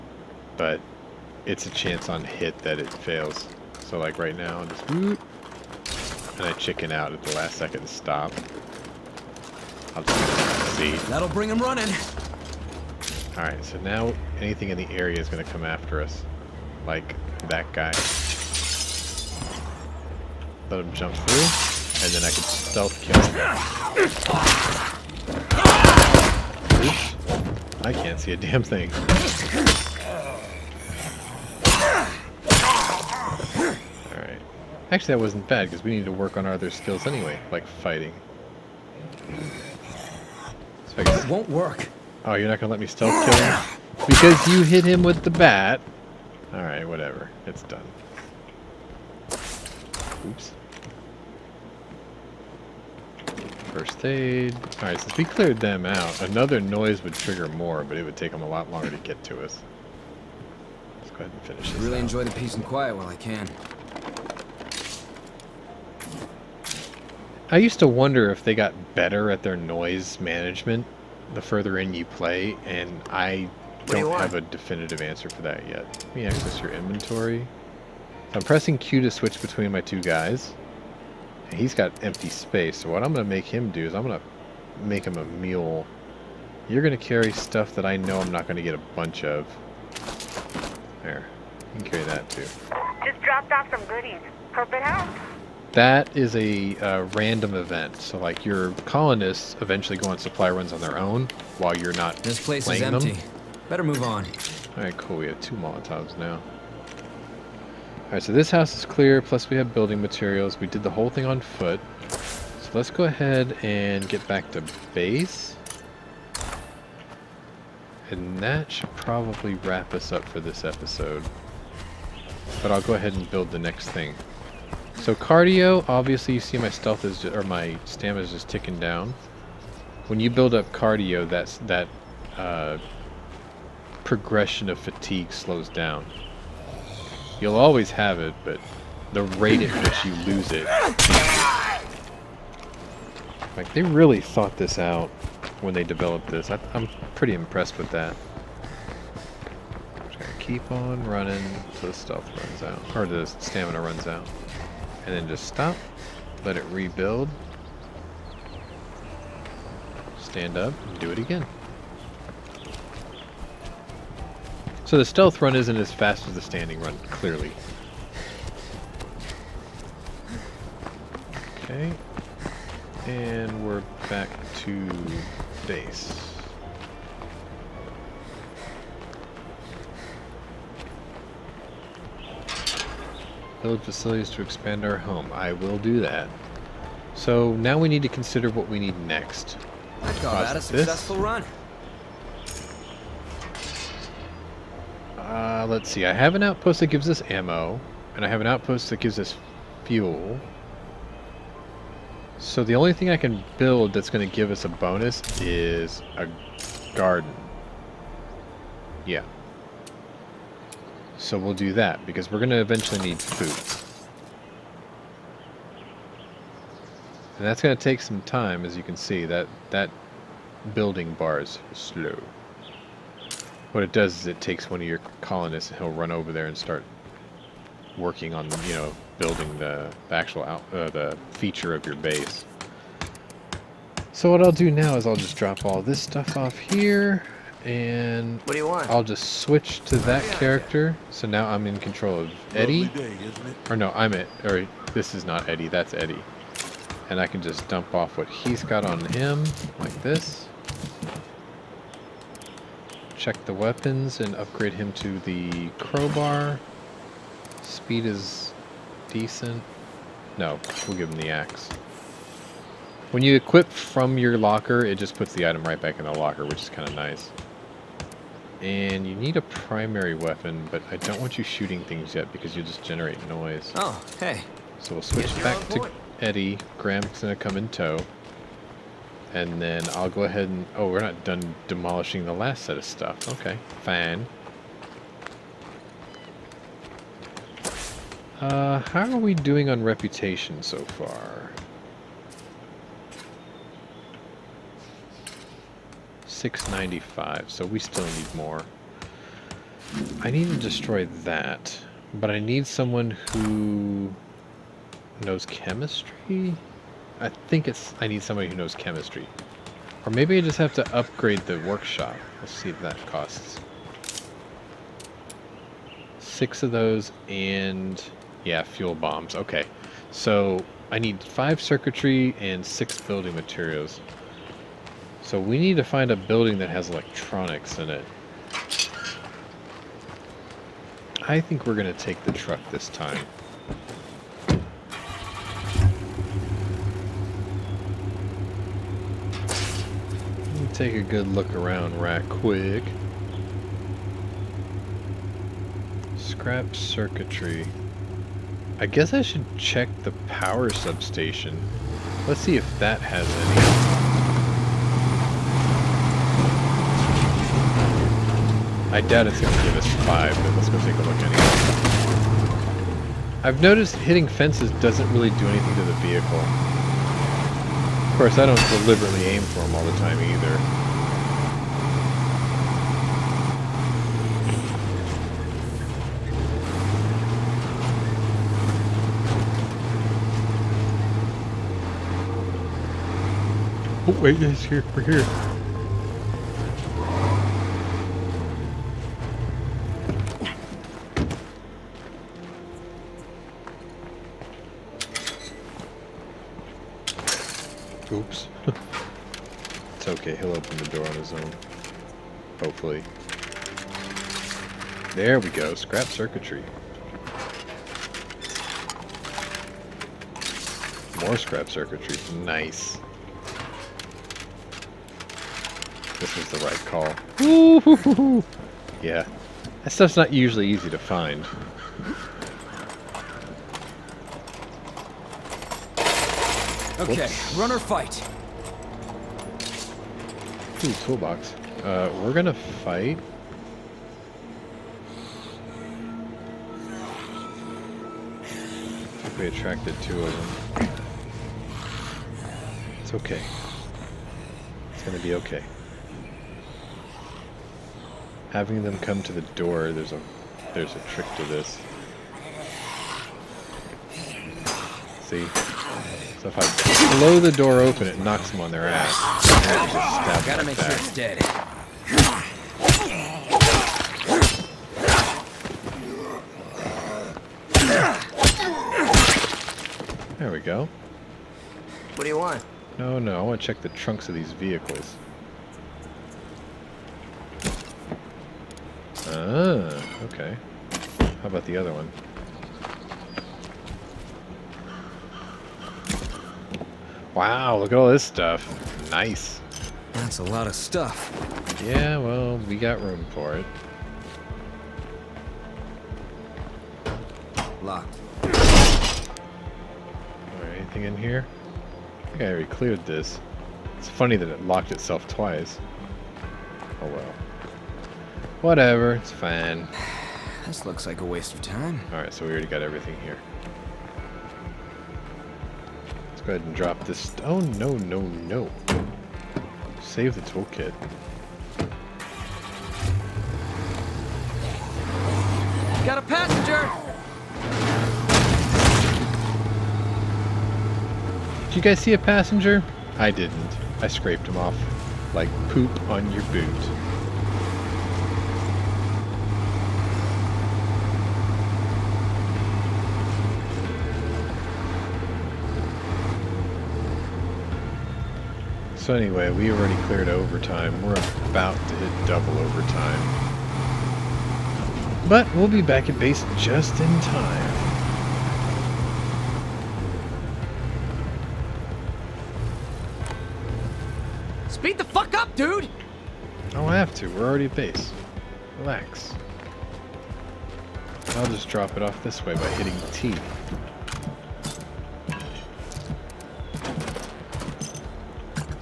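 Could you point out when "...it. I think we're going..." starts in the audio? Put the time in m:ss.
5:27.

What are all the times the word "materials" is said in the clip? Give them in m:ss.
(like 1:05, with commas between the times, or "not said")
1:50, 5:23.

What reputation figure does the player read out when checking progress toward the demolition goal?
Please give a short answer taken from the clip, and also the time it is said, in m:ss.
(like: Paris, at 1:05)
695, at 4:56.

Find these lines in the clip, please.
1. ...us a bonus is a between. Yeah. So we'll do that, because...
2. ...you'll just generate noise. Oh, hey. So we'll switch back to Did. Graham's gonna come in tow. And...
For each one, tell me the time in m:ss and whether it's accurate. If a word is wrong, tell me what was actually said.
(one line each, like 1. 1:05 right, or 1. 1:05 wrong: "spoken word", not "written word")
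1. 3:24 wrong: "garden", not "between"
2. 4:32 wrong: "Eddie", not "Did".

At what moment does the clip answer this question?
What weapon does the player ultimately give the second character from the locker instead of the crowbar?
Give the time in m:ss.
4:21.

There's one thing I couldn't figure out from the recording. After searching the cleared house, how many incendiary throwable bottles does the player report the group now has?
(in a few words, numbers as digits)
2.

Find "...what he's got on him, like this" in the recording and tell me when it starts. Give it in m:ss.
4:08.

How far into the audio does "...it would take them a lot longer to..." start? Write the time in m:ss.
0:57.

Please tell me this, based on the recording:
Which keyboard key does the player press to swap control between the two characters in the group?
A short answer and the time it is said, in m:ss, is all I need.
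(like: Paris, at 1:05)
Q, at 1:18.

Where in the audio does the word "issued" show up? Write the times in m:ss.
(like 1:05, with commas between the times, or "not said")
not said.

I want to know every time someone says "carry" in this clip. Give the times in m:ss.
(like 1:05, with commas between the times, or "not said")
1:27, 1:31.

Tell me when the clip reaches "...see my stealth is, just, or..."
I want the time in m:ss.
2:06.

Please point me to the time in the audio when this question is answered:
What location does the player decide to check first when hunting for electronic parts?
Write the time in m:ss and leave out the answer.
5:50.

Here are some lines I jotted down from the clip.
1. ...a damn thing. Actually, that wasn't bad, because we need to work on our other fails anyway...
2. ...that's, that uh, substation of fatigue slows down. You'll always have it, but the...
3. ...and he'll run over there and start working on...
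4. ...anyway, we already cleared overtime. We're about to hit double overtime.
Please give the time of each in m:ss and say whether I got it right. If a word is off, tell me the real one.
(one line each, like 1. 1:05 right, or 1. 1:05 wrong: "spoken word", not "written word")
1. 0:28 wrong: "skills", not "fails"
2. 2:11 wrong: "progression", not "substation"
3. 3:45 right
4. 9:09 right.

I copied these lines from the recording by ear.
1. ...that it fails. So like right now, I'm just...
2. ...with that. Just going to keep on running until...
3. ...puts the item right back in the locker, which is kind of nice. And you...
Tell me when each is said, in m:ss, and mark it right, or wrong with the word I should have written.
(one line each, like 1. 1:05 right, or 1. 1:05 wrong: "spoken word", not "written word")
1. 0:02 right
2. 2:27 right
3. 4:25 right.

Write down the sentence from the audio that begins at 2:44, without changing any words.
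So the stealth run isn't as fast as the standing run, clearly.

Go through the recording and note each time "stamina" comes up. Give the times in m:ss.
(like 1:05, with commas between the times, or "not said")
2:07, 2:33.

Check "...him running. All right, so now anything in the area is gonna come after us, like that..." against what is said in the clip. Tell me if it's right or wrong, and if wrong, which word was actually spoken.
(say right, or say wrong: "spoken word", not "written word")
right.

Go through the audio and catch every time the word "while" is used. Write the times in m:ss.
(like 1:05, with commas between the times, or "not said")
1:02, 1:41.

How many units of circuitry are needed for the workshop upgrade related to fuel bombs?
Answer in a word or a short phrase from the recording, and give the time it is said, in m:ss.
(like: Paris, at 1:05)
5, at 5:21.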